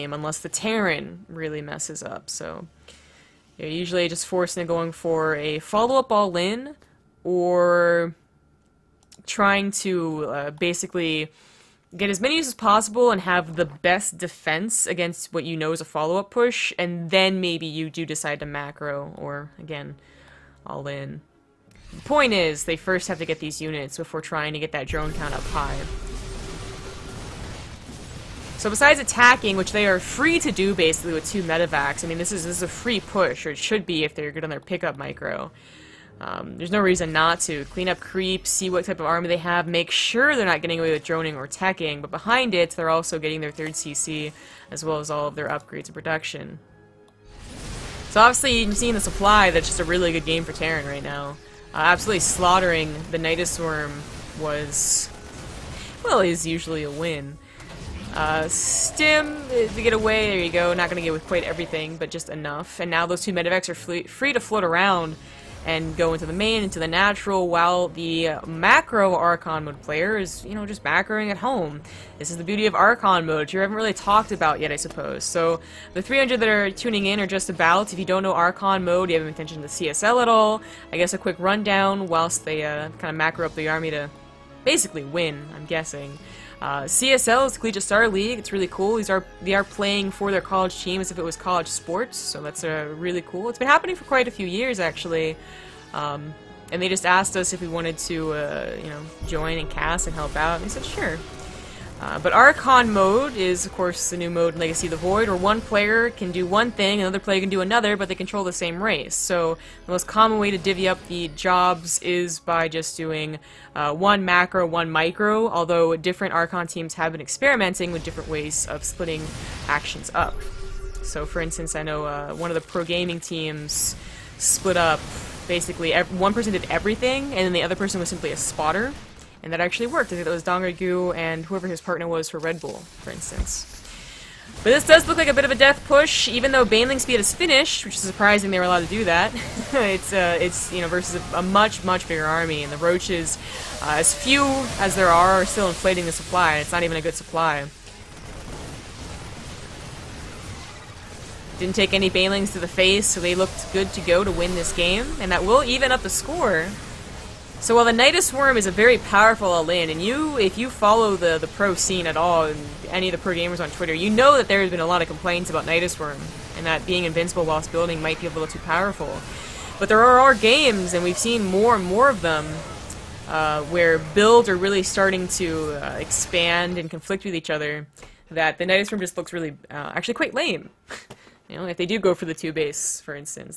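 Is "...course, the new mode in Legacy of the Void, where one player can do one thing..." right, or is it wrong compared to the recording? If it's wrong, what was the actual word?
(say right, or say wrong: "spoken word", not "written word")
right.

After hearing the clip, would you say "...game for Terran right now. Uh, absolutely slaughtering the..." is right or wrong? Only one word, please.
right.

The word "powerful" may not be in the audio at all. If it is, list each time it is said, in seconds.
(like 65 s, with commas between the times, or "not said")
158 s, 168 s.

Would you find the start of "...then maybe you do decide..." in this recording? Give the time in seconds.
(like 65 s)
17 s.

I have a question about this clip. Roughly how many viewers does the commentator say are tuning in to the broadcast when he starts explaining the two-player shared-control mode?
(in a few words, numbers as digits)
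300.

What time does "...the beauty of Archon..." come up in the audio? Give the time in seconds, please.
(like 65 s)
72 s.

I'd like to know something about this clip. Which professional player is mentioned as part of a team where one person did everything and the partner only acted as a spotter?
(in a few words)
DongRaeGu.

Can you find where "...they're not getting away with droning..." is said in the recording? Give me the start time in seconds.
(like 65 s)
40 s.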